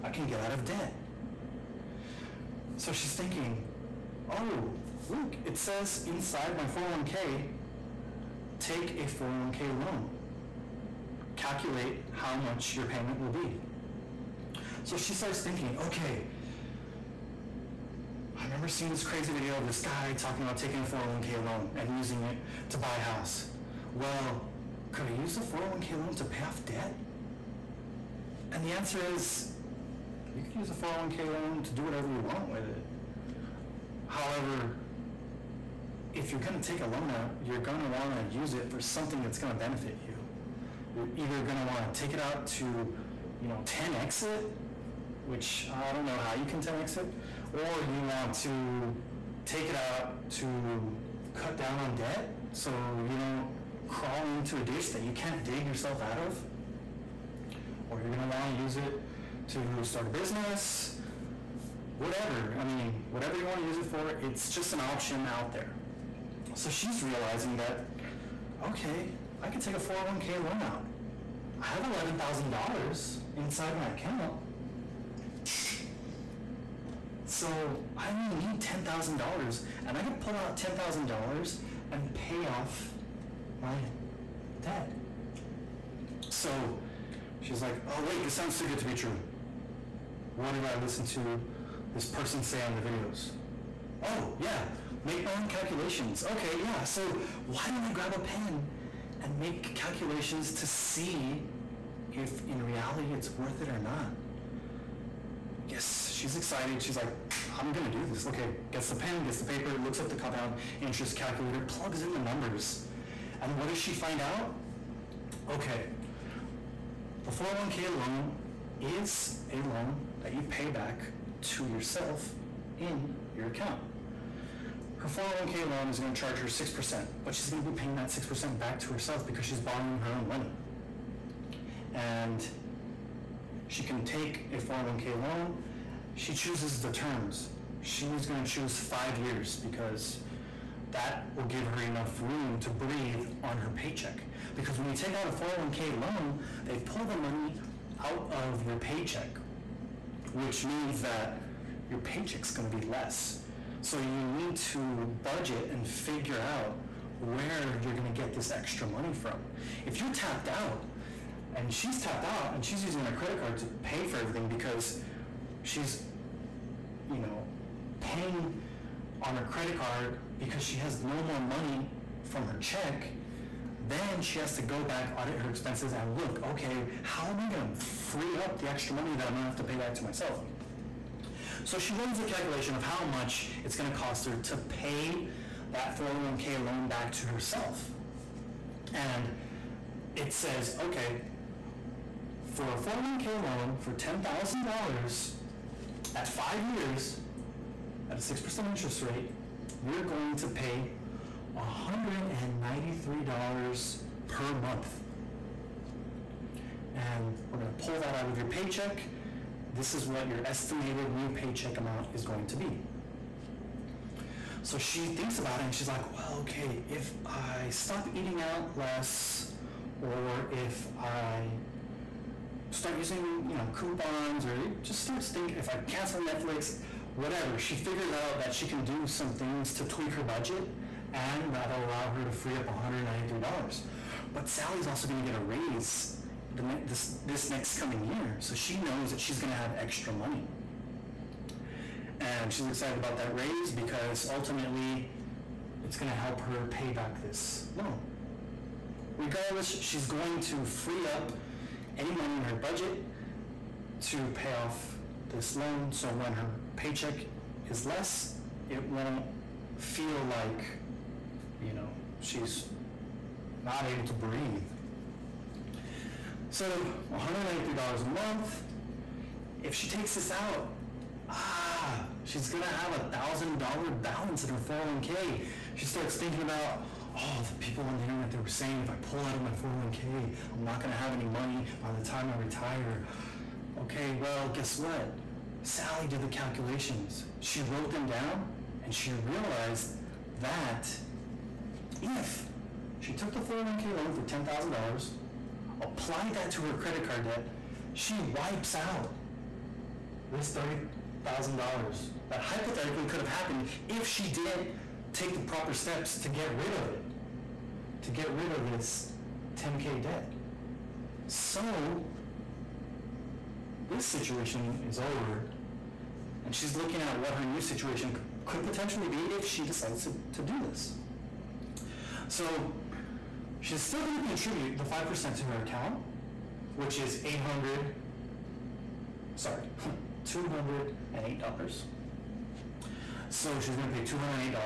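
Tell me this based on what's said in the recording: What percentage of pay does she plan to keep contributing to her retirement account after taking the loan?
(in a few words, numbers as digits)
5%.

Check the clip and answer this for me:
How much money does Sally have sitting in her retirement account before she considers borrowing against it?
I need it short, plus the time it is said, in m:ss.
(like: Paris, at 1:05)
$11,000, at 1:11.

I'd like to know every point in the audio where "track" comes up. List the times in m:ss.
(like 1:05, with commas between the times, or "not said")
not said.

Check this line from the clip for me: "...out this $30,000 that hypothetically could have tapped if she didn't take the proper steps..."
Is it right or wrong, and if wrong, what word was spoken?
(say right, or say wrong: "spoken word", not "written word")
wrong: "happened", not "tapped".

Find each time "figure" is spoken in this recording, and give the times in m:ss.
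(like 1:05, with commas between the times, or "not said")
2:35, 3:47.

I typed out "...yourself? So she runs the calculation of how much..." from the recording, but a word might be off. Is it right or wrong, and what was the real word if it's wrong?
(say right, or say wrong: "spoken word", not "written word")
wrong: "myself", not "yourself".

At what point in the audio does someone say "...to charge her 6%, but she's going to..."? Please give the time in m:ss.
2:06.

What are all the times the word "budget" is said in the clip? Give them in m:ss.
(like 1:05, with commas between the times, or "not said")
2:35, 3:50, 4:12.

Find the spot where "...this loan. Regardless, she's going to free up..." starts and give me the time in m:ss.
4:07.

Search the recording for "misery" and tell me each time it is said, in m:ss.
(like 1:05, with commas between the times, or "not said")
not said.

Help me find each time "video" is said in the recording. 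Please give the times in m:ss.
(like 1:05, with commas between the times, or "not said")
0:19, 1:32.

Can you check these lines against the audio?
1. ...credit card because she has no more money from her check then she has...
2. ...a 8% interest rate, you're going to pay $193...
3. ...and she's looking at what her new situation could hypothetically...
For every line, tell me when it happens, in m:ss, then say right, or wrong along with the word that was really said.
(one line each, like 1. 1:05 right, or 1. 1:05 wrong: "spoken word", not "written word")
1. 2:49 right
2. 3:18 wrong: "6", not "8"
3. 5:16 wrong: "potentially", not "hypothetically".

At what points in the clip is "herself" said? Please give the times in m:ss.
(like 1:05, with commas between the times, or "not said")
2:08, 3:07.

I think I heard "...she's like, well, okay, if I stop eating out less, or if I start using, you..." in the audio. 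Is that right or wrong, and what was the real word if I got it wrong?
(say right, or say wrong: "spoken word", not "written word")
right.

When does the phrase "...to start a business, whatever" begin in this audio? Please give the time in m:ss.
0:59.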